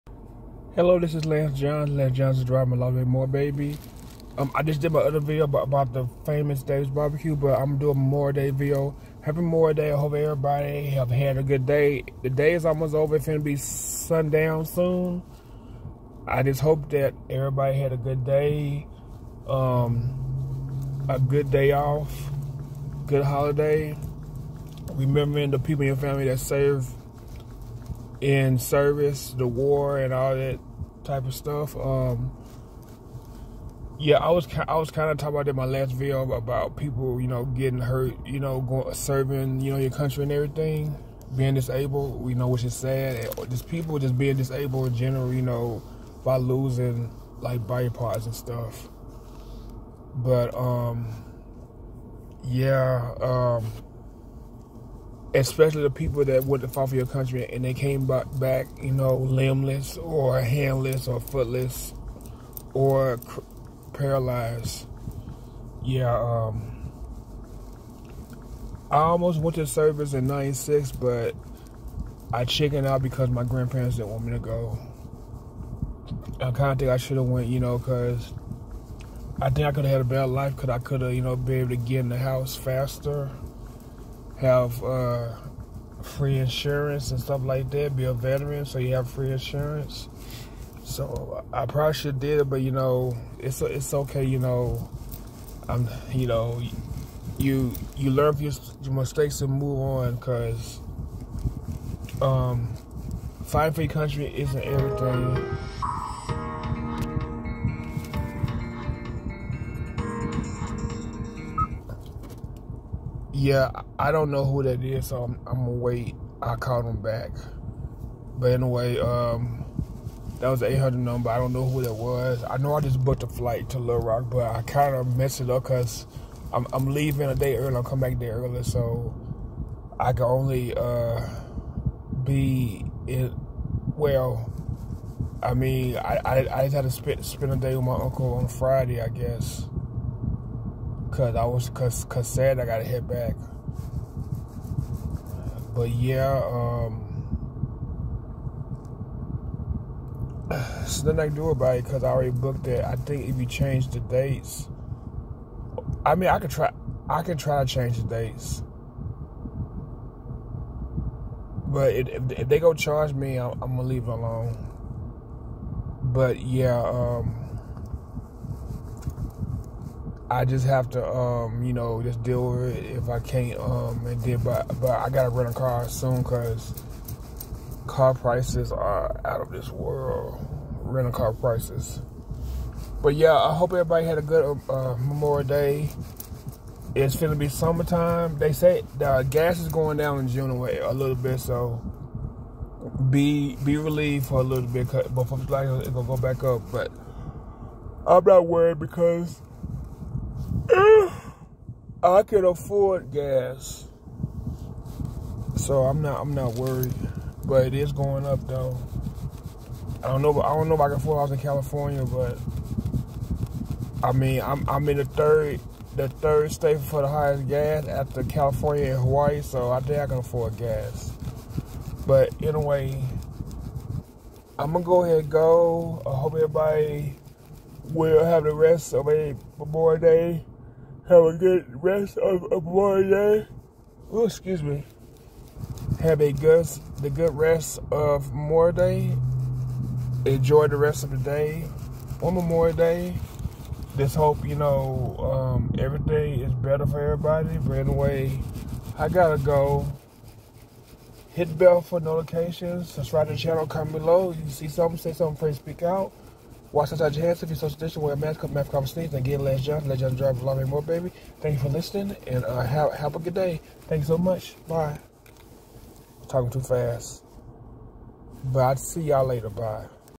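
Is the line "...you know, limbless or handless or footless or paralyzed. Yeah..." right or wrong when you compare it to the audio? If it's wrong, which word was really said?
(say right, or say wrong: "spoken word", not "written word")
right.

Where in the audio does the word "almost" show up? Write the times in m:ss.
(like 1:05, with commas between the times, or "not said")
0:12, 1:08.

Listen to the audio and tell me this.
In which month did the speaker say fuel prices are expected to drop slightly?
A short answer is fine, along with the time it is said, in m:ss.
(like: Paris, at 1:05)
June, at 3:10.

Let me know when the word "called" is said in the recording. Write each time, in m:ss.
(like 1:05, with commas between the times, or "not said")
1:56.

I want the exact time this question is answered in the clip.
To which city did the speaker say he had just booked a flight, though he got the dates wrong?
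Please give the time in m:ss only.
2:03.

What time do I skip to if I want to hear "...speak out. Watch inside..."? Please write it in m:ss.
4:15.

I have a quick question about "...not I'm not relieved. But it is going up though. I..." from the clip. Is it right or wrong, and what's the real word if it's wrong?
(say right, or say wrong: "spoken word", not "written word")
wrong: "worried", not "relieved".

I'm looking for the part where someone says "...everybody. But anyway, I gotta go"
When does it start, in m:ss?
4:07.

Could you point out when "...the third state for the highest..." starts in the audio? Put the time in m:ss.
3:35.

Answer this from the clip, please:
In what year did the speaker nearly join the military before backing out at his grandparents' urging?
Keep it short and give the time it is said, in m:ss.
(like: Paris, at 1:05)
1996, at 1:10.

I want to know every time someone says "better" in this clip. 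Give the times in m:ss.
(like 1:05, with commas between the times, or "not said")
1:20, 4:06.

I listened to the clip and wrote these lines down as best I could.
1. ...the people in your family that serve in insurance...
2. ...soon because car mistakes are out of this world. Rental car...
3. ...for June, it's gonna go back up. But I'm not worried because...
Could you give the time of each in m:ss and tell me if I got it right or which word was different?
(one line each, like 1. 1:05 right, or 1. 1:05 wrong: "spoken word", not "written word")
1. 0:25 wrong: "service", not "insurance"
2. 2:55 wrong: "prices", not "mistakes"
3. 3:15 wrong: "July", not "June".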